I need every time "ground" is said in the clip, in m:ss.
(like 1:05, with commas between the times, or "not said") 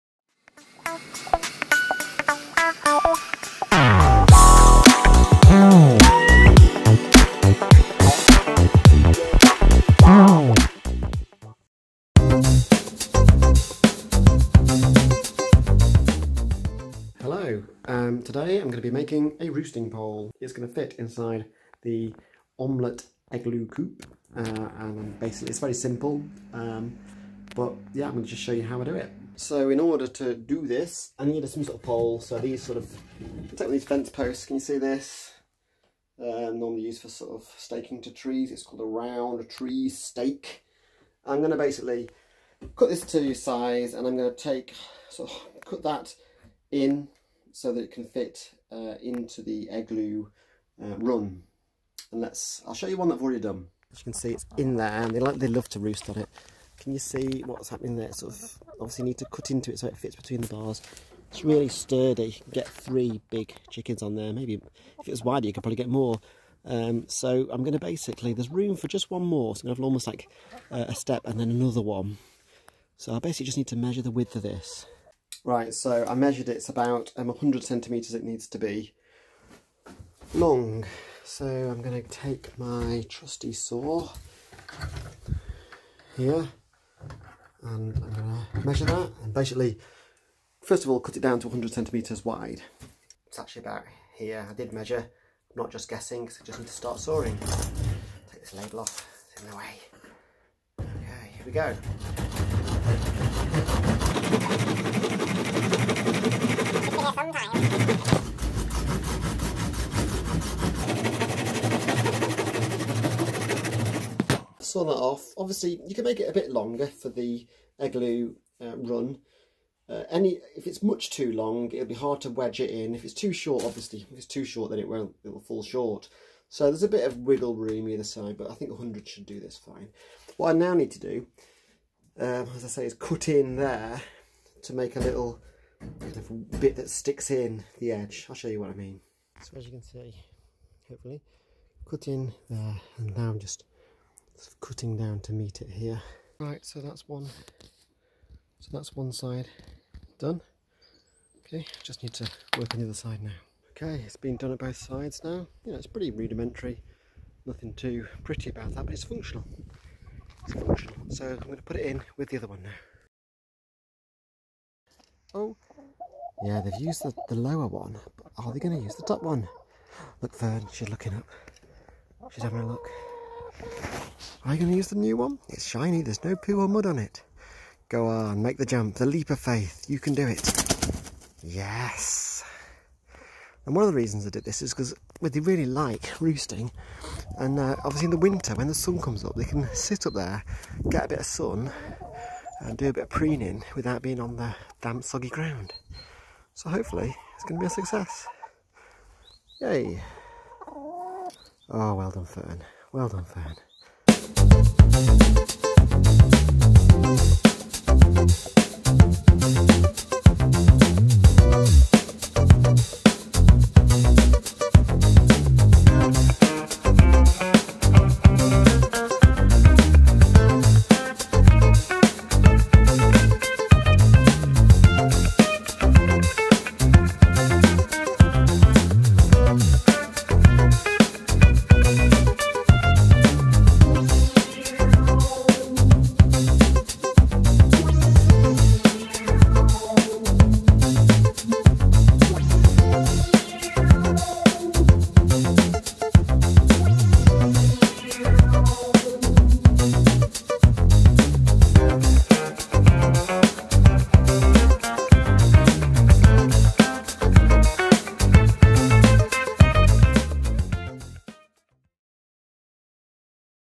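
3:15.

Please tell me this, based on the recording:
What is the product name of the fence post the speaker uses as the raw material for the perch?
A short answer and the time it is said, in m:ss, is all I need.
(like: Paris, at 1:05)
round tree stake, at 0:38.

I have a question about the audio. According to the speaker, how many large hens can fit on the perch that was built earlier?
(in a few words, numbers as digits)
3.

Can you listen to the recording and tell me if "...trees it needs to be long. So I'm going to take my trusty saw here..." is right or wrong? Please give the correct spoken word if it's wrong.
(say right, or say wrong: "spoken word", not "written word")
wrong: "centimetres", not "trees".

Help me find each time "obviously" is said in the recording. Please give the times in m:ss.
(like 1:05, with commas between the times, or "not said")
0:58, 1:55, 2:03, 3:07.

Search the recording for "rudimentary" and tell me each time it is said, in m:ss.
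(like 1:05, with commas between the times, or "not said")
2:36.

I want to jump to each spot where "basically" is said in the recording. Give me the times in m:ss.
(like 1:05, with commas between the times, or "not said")
0:25, 0:41, 1:07, 1:13, 1:29.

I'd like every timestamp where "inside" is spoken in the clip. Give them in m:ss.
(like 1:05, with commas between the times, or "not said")
0:20.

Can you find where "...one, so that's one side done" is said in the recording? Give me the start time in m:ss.
2:27.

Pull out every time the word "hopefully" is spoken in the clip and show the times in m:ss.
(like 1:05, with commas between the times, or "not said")
2:20, 3:16.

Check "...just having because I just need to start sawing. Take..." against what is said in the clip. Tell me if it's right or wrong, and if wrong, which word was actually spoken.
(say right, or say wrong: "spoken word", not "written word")
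wrong: "guessing", not "having".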